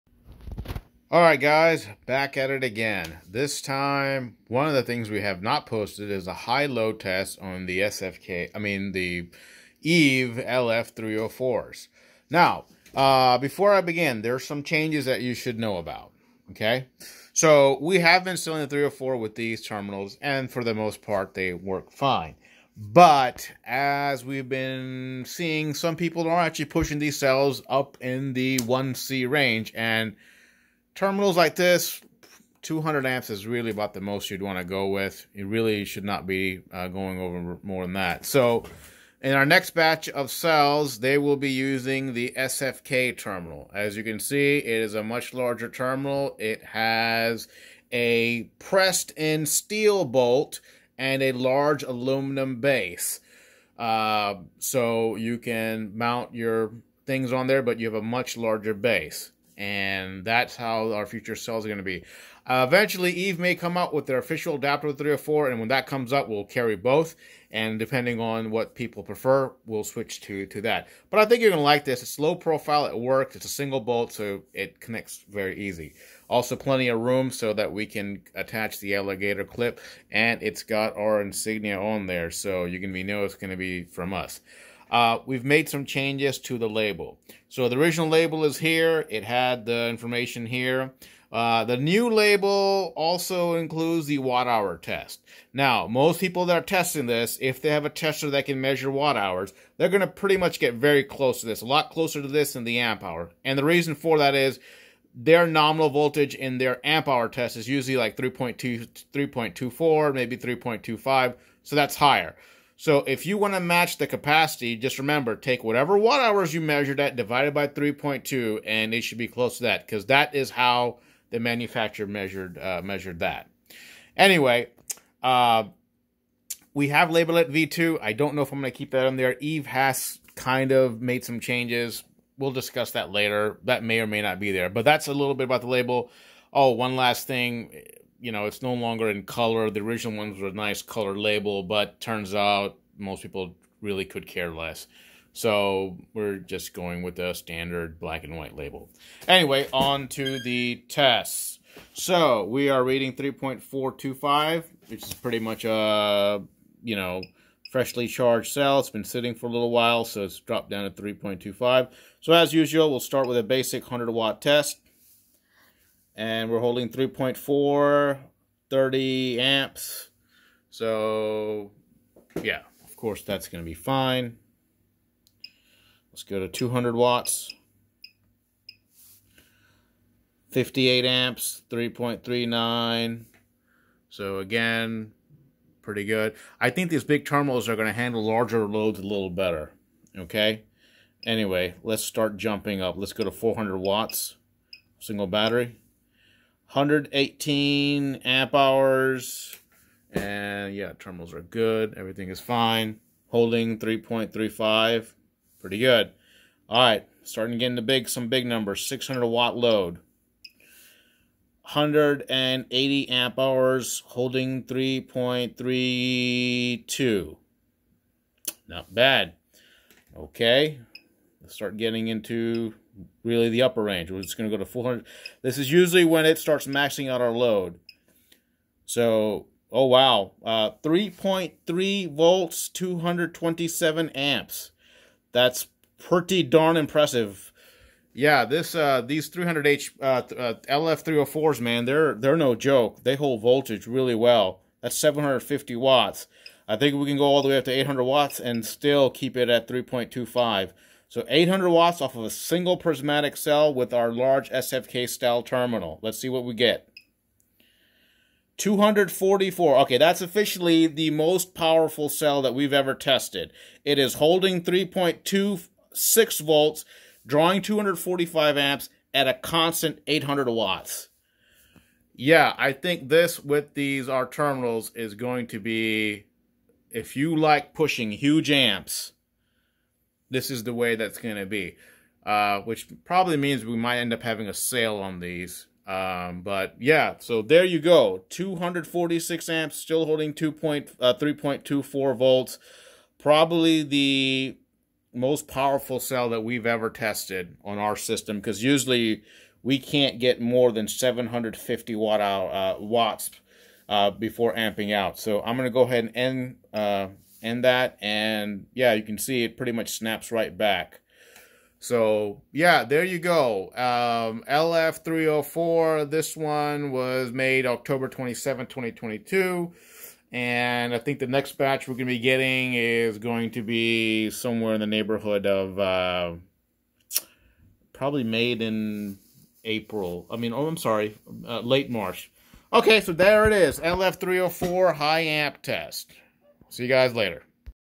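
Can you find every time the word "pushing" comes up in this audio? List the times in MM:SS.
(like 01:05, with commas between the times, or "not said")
00:26, 04:37.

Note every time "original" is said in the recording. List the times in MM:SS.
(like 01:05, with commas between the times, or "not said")
01:27, 02:19.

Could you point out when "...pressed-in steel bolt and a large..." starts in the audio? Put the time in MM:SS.
00:48.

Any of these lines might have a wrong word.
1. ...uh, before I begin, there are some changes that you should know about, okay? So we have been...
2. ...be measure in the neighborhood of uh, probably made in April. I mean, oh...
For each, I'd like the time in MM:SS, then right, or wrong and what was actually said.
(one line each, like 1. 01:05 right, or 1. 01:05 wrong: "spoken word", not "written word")
1. 00:12 right
2. 05:23 wrong: "somewhere", not "measure".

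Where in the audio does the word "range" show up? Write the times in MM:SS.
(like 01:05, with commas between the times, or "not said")
00:29, 03:43.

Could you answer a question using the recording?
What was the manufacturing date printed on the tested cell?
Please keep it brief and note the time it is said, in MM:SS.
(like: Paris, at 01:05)
October 27, 2022, at 05:17.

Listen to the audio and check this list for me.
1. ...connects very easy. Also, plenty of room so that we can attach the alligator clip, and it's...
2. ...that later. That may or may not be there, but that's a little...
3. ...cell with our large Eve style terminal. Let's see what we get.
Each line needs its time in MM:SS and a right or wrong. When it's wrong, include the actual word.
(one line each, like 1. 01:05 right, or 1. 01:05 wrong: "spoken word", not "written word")
1. 01:14 right
2. 02:12 right
3. 04:13 wrong: "SFK", not "Eve".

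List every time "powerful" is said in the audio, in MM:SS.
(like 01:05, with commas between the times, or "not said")
04:21, 04:55.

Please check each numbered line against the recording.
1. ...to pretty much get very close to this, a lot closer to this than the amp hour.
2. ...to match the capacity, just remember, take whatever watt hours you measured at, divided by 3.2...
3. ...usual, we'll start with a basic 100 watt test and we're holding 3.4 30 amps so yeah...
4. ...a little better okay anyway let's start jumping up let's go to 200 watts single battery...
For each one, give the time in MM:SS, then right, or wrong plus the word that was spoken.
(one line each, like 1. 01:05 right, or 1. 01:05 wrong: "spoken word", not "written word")
1. 01:40 right
2. 01:53 right
3. 02:42 right
4. 03:08 wrong: "400", not "200".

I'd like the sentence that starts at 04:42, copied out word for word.
Uh, which probably means we might end up having a sale on these.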